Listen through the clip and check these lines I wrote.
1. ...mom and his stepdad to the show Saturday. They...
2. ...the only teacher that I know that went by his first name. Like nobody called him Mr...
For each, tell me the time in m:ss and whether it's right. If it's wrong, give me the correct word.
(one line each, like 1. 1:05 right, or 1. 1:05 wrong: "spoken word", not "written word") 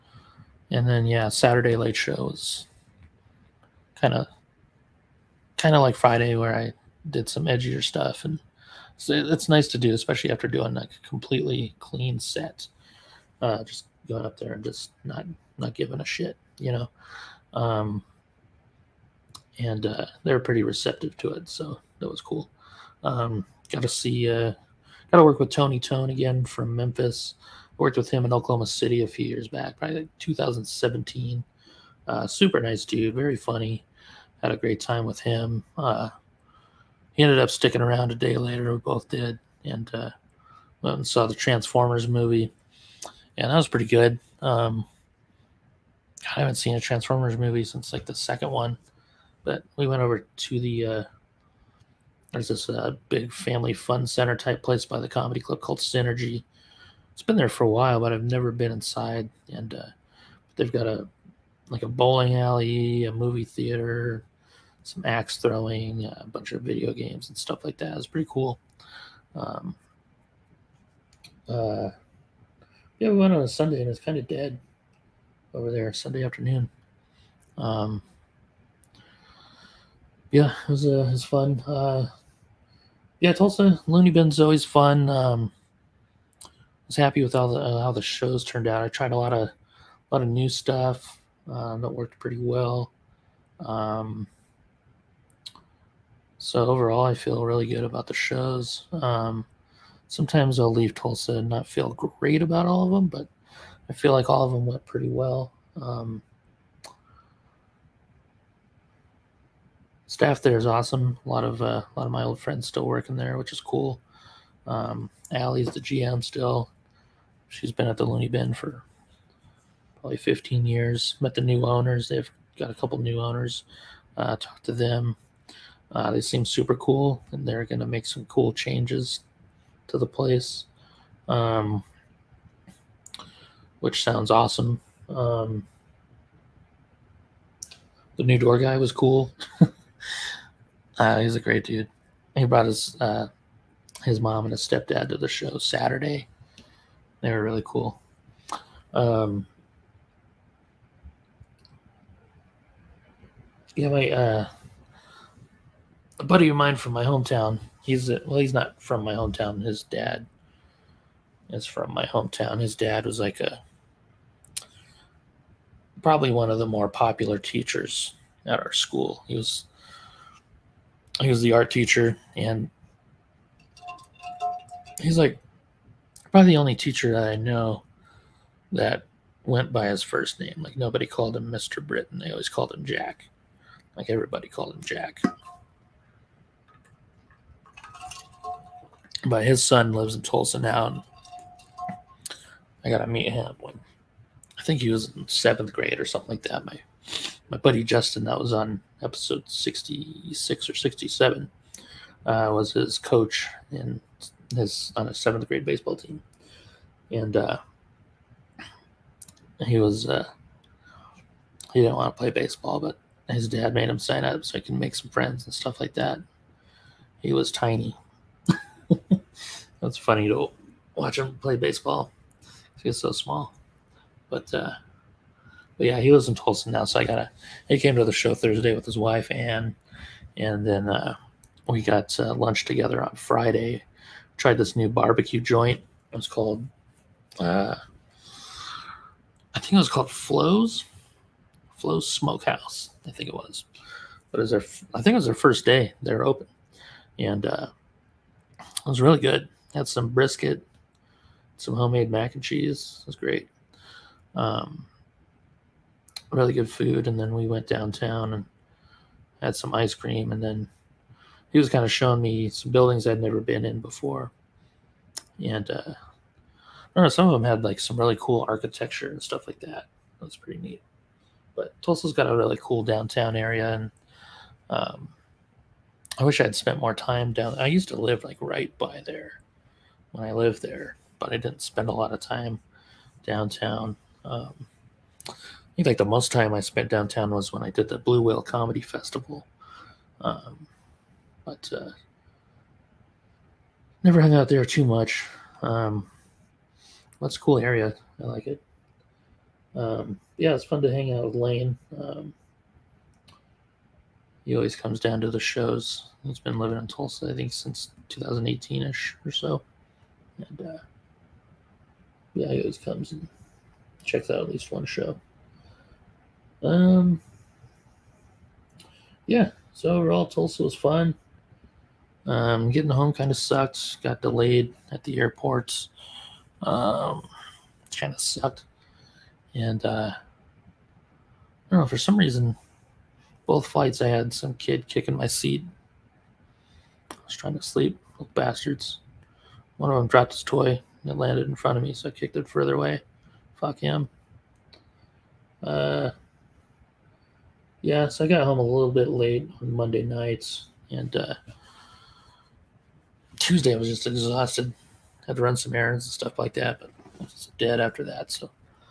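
1. 2:24 right
2. 2:56 right.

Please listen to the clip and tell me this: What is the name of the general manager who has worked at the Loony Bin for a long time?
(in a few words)
Allie.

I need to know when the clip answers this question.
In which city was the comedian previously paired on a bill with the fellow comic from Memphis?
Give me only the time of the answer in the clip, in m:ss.
0:28.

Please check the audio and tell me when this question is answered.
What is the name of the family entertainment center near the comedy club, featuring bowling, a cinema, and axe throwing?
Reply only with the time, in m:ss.
0:55.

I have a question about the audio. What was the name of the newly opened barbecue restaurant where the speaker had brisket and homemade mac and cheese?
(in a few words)
Flows Smokehouse.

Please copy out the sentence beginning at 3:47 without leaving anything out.
He came to the show Thursday with his wife and and then uh, we got uh, lunch together on Friday.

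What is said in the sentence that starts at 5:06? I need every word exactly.
He's been living in Tulsa, I think, since 2018 ish or so.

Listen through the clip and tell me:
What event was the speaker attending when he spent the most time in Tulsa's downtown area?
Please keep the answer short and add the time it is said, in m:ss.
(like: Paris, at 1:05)
Blue Whale Comedy Festival, at 4:47.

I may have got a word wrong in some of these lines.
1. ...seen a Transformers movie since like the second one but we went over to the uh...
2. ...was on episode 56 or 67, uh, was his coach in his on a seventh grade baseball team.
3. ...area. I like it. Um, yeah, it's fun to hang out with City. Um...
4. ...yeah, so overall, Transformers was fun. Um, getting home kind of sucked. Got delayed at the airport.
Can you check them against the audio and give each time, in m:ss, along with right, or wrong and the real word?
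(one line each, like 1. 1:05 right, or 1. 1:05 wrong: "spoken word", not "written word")
1. 0:46 right
2. 3:18 wrong: "66", not "56"
3. 4:57 wrong: "Lane", not "City"
4. 5:19 wrong: "Tulsa", not "Transformers".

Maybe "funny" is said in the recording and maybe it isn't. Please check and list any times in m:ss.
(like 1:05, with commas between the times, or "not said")
0:33, 3:39.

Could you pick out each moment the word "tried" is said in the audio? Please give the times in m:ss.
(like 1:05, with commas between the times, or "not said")
1:28, 3:54.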